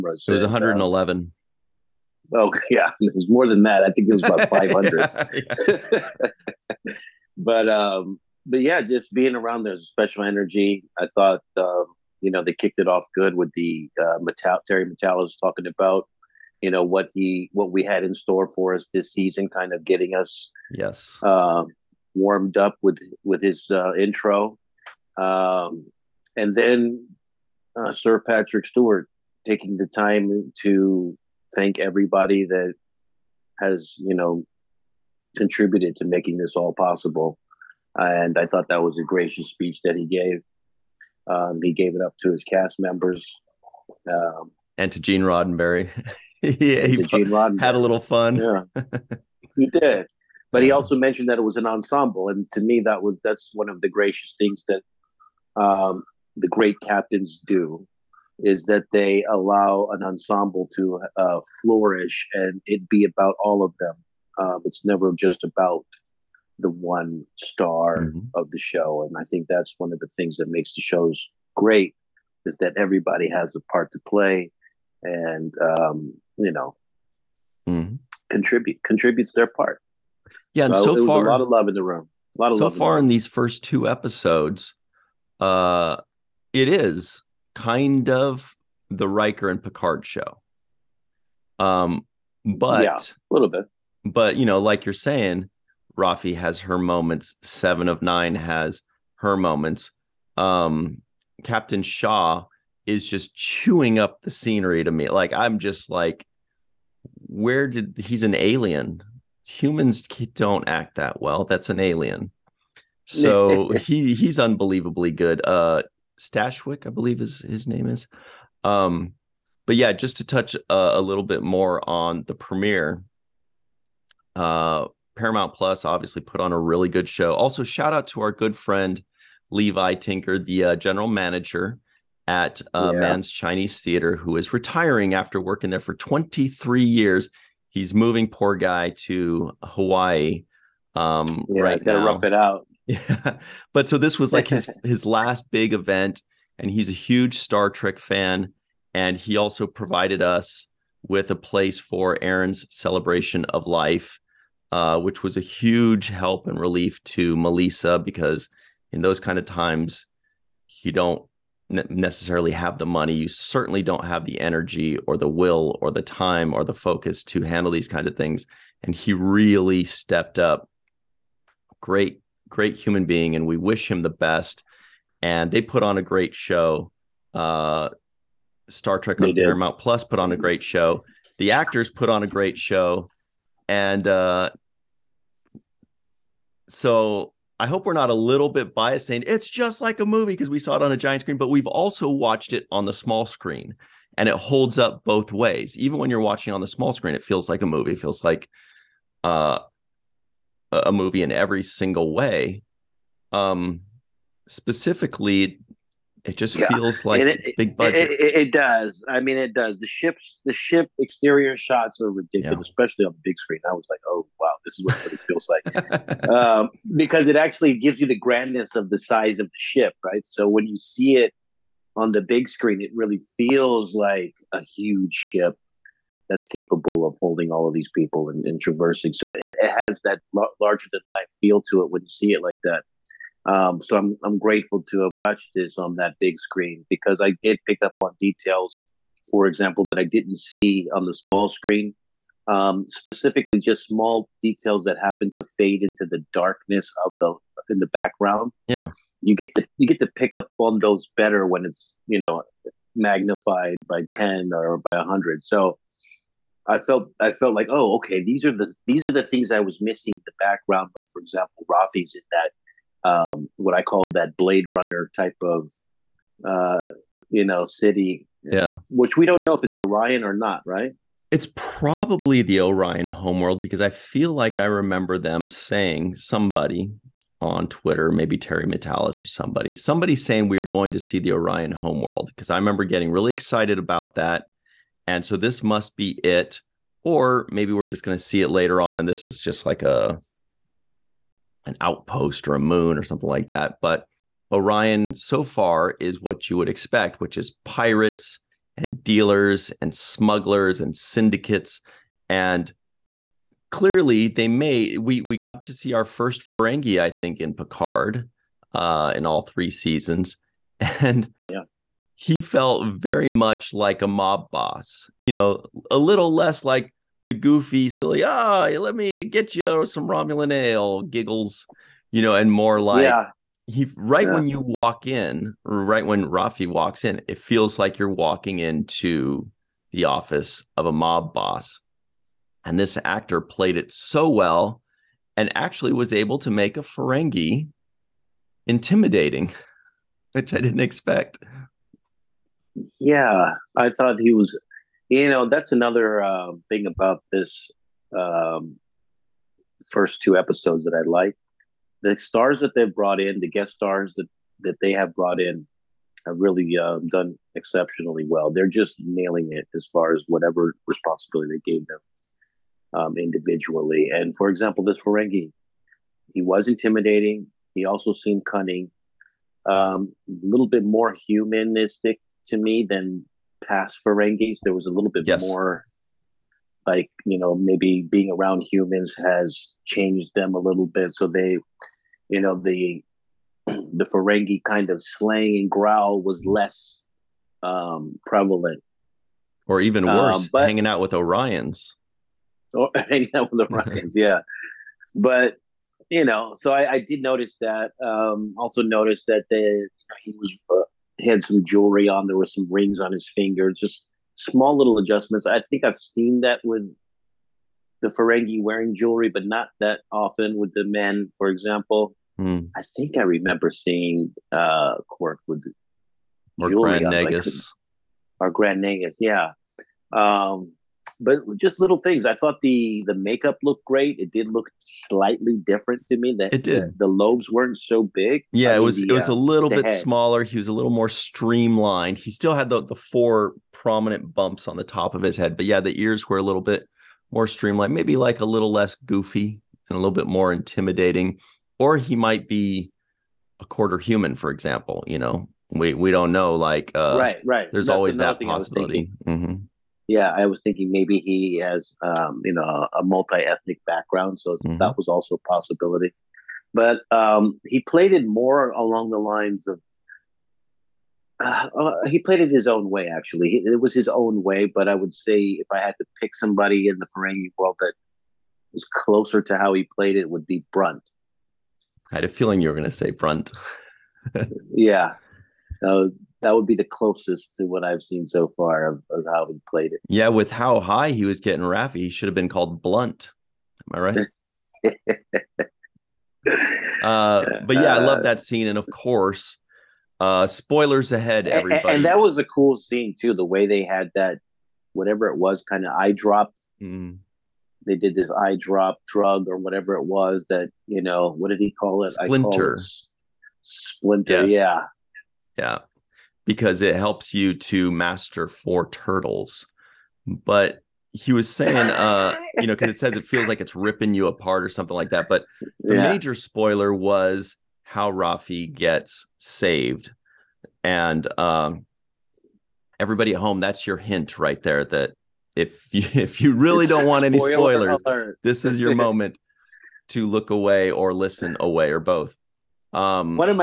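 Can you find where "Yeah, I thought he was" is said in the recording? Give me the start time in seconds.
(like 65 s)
342 s.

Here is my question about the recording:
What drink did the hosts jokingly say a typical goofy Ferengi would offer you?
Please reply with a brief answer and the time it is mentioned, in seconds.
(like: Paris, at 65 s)
Romulan ale, at 320 s.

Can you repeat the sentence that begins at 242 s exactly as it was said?
Um, specifically, just small details that happen to fade into the darkness of the in the background.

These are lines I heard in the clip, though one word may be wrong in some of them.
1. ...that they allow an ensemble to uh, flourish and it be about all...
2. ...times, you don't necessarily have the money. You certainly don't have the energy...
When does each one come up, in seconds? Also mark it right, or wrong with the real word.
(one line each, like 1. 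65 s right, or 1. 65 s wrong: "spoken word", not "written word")
1. 58 s right
2. 159 s right.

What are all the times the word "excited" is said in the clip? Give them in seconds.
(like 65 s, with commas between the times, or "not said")
283 s.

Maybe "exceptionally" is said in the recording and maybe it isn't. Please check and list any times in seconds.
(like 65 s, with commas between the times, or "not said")
357 s.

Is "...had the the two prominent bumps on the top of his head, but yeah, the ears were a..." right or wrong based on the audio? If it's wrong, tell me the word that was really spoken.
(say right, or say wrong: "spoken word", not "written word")
wrong: "four", not "two".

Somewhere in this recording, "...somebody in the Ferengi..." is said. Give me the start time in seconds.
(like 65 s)
466 s.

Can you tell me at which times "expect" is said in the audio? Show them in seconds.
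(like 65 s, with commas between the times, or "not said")
296 s, 340 s.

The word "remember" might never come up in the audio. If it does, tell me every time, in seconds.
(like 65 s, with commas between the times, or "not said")
274 s, 282 s, 413 s.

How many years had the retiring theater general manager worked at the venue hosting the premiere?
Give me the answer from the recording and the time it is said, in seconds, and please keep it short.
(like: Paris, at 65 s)
23, at 135 s.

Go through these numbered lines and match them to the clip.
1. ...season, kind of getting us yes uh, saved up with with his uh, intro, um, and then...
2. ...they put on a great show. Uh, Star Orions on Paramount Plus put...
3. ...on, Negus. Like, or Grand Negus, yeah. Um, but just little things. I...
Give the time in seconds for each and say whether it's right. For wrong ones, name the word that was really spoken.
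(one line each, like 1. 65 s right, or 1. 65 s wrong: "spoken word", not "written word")
1. 19 s wrong: "warmed", not "saved"
2. 175 s wrong: "Trek", not "Orions"
3. 417 s right.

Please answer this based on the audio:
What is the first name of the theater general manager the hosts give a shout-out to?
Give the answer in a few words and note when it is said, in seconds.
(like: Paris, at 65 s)
Levi, at 129 s.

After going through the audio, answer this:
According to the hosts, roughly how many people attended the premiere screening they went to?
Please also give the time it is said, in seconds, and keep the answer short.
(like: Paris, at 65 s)
500, at 6 s.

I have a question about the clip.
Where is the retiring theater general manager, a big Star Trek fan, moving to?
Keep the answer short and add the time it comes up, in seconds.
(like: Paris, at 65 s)
Hawaii, at 139 s.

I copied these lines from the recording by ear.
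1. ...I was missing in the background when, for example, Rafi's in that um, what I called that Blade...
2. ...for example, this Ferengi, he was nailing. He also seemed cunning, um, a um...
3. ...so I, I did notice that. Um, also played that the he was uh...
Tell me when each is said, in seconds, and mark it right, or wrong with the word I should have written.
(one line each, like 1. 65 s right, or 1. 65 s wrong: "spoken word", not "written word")
1. 259 s right
2. 364 s wrong: "intimidating", not "nailing"
3. 396 s wrong: "noticed", not "played".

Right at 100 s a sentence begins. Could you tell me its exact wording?
Um, Captain Shaw is just chewing up the scenery to me.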